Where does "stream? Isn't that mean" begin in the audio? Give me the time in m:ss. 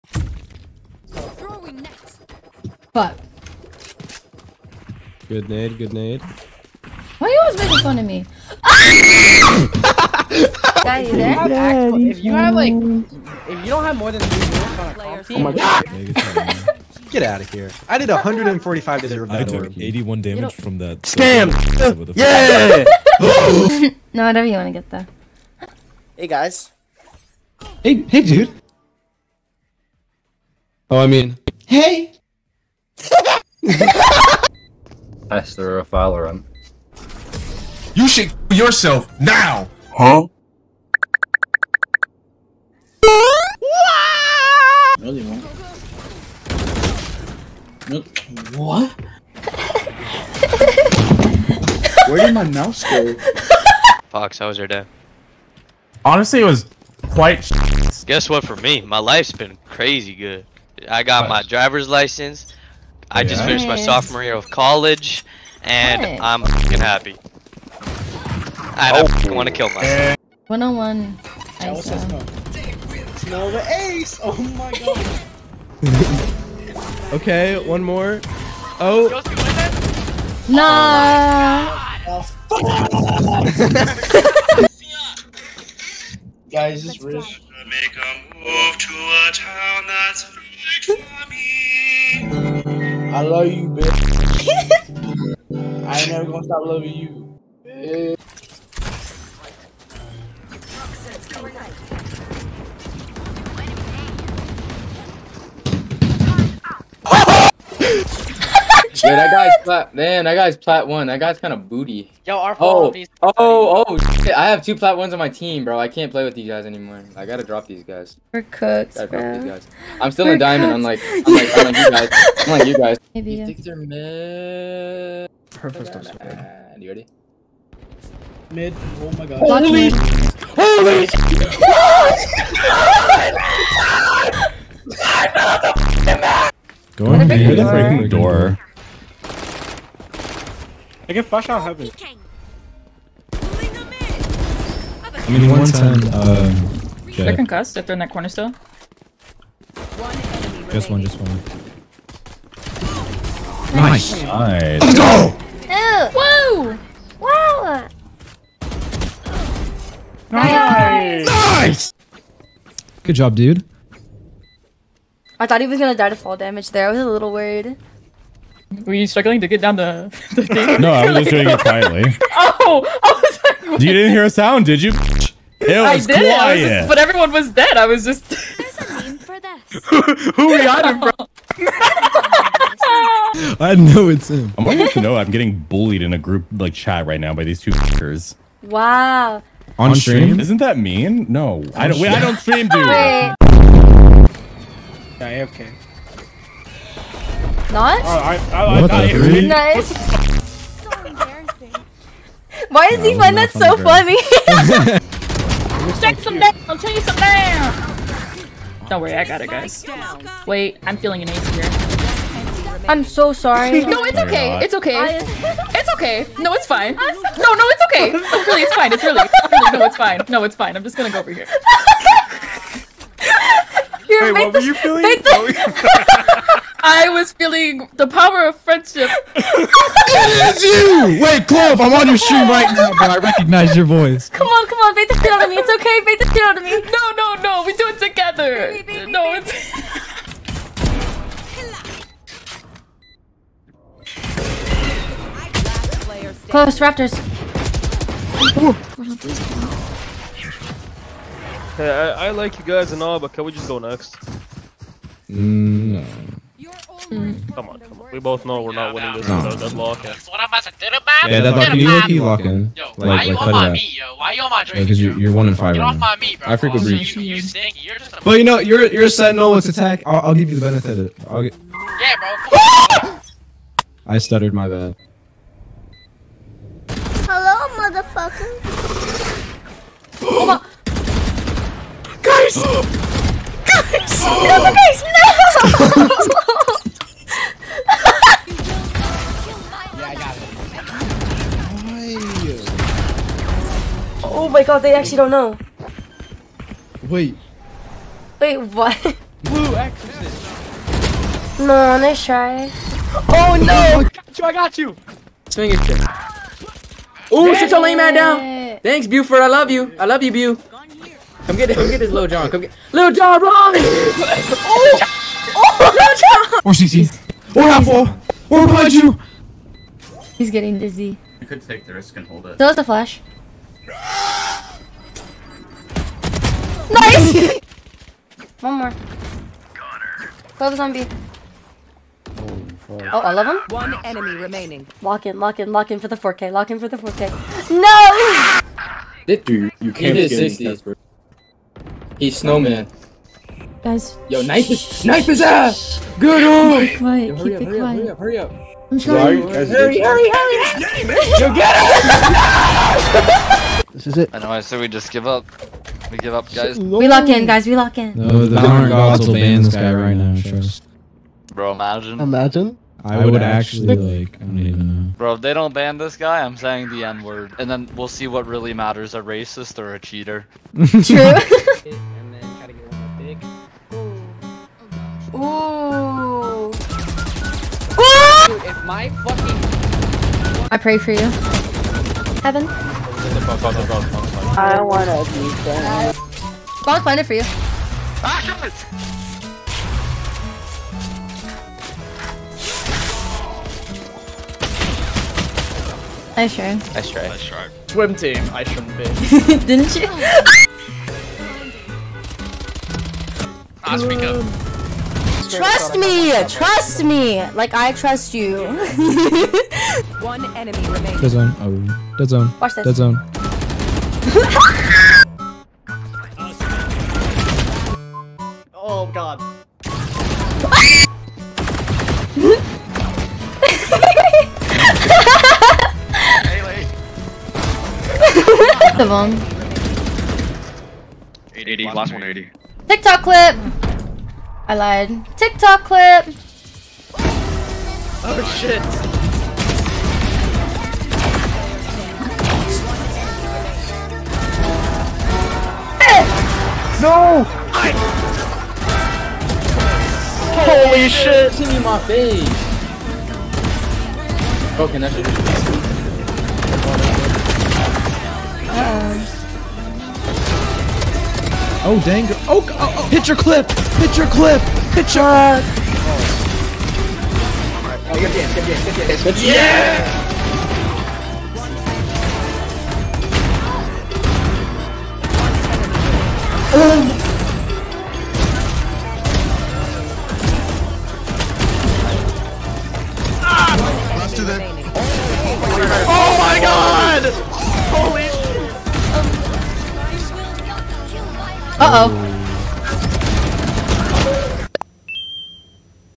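3:10.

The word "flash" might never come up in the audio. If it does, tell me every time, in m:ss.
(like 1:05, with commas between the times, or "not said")
2:21, 5:22.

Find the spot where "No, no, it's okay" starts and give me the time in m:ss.
3:36.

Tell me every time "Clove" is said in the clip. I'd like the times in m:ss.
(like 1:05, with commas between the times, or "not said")
3:51, 5:30.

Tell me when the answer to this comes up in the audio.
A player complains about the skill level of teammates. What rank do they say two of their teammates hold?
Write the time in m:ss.
1:54.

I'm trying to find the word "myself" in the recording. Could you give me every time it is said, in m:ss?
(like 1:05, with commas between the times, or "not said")
1:09.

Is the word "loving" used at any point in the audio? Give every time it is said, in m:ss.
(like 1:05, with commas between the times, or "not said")
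1:36.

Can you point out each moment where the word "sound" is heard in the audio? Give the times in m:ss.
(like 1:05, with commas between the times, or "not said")
2:54.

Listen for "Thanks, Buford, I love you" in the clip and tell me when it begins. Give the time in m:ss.
5:08.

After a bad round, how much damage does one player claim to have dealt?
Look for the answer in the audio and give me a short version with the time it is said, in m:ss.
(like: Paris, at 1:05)
145, at 0:18.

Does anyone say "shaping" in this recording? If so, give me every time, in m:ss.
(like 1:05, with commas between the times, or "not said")
not said.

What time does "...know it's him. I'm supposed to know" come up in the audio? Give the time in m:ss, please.
3:03.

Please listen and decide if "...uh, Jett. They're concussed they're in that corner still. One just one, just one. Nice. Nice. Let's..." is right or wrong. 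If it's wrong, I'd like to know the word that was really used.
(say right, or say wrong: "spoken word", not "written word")
right.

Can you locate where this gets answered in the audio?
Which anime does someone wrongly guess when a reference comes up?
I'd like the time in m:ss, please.
4:59.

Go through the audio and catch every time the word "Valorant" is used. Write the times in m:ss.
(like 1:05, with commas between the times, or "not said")
0:35, 5:58.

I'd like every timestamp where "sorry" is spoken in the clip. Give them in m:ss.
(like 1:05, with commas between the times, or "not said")
3:33, 5:48.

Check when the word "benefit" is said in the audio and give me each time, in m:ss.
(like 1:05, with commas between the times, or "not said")
4:30.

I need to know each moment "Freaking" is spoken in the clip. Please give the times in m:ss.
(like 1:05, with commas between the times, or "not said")
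2:17.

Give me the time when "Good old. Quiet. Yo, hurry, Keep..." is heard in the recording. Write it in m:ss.
5:46.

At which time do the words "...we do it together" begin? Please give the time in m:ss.
3:57.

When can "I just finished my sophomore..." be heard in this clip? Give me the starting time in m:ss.
1:03.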